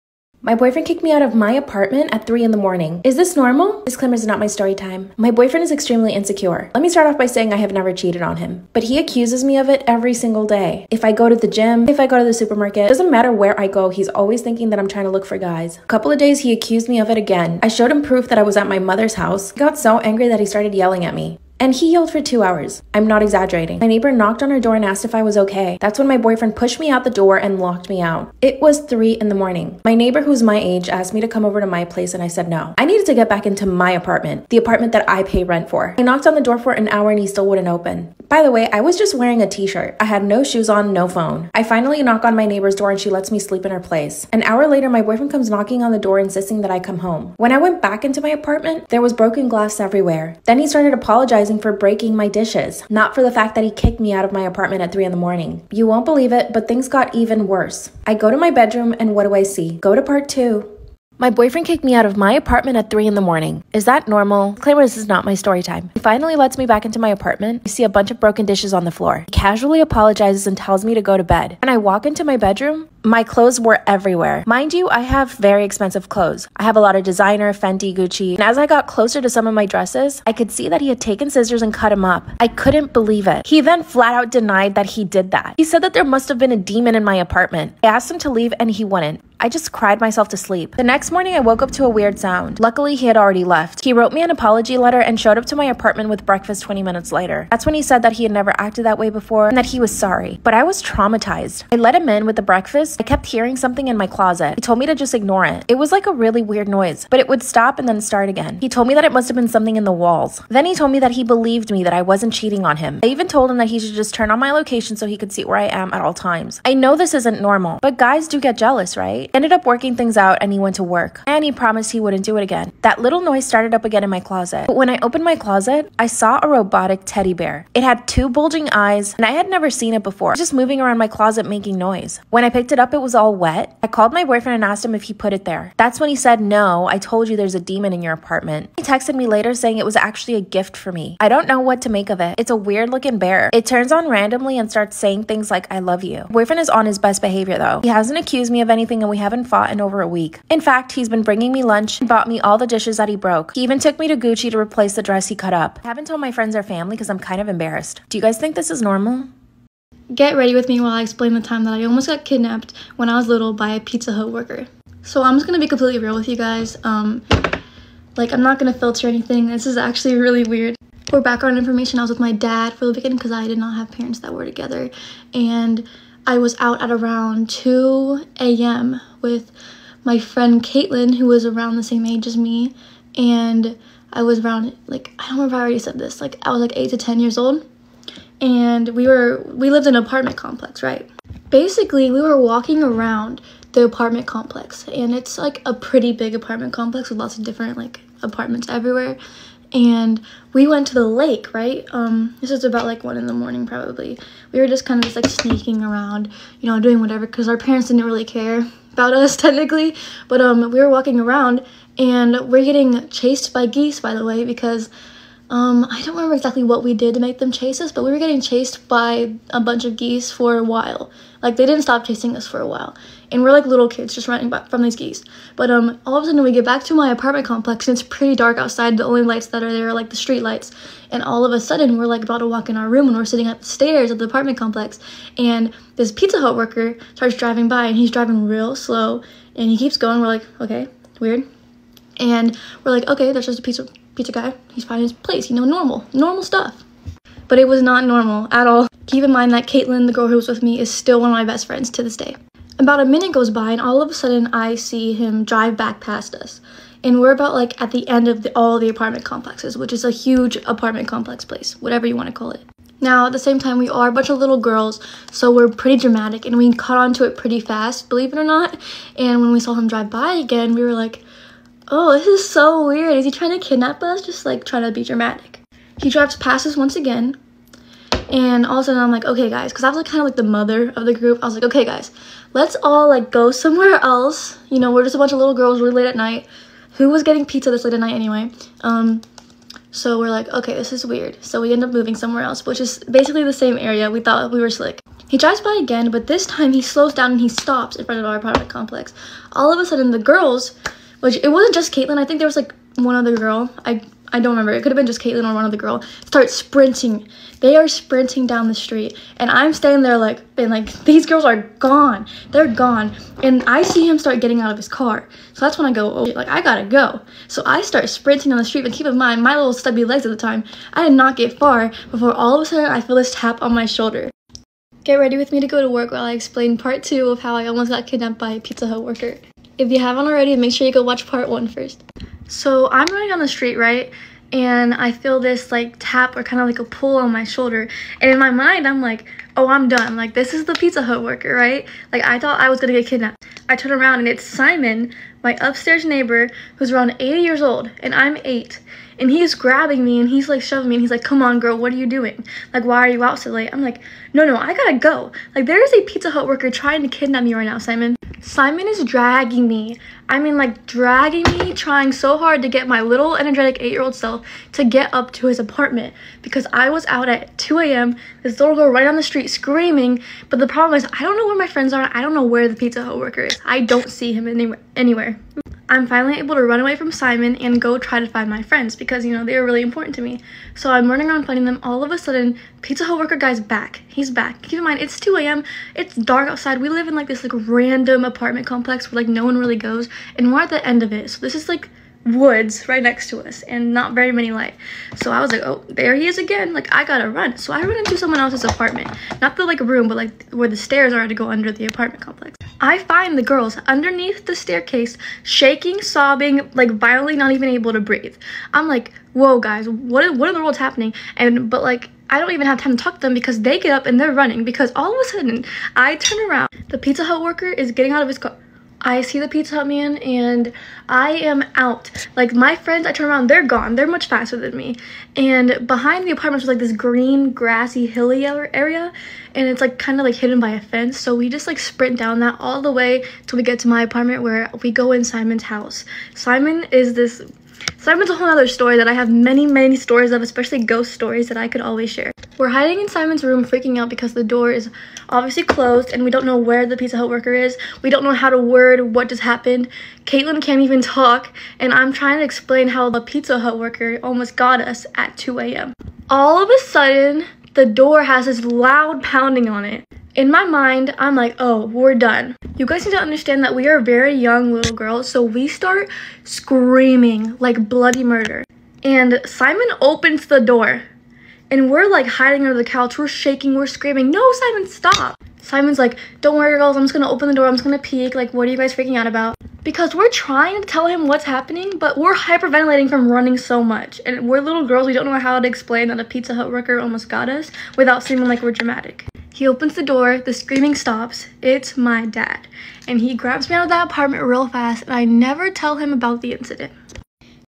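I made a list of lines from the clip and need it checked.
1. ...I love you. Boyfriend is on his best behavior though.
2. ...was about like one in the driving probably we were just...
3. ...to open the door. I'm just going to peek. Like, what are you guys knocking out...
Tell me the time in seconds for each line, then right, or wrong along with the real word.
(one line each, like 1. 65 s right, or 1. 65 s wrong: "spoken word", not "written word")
1. 145 s right
2. 202 s wrong: "morning", not "driving"
3. 477 s wrong: "freaking", not "knocking".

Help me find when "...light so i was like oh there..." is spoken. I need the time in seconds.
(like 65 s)
394 s.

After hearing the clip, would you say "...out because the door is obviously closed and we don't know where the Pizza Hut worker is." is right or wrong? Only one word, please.
right.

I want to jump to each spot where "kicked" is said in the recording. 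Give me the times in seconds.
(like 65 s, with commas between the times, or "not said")
0 s, 53 s, 61 s.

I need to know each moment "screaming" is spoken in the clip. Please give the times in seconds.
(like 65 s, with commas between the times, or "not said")
369 s, 466 s, 473 s, 490 s.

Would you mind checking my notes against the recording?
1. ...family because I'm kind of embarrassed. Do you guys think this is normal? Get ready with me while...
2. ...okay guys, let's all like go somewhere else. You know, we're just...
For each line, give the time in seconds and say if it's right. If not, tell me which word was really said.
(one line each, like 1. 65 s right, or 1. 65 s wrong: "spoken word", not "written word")
1. 156 s right
2. 281 s right.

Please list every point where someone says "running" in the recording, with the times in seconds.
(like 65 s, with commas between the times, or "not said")
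224 s, 333 s, 381 s, 414 s, 483 s.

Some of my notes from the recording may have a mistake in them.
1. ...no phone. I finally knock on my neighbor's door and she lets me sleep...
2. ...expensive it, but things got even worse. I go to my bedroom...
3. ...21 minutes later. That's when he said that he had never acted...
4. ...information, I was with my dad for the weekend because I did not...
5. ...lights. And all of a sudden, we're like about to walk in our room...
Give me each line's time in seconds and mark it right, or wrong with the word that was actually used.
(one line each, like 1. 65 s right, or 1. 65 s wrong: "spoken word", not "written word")
1. 40 s right
2. 56 s wrong: "believe", not "expensive"
3. 96 s wrong: "20", not "21"
4. 171 s right
5. 230 s right.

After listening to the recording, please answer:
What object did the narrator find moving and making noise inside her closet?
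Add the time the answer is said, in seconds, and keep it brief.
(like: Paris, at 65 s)
Robotic teddy bear, at 126 s.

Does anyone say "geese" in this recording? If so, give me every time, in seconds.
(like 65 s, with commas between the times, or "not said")
213 s, 219 s, 224 s.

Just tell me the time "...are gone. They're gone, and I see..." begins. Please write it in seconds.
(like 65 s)
311 s.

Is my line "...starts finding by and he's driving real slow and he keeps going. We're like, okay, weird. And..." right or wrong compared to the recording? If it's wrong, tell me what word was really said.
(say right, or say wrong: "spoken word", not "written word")
wrong: "driving", not "finding".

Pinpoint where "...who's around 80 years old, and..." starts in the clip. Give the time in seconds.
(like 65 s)
346 s.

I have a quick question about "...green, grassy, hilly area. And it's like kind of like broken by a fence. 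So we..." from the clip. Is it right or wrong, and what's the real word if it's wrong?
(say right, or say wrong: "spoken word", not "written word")
wrong: "hidden", not "broken".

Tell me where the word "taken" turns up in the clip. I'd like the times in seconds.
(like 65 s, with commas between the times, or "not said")
81 s.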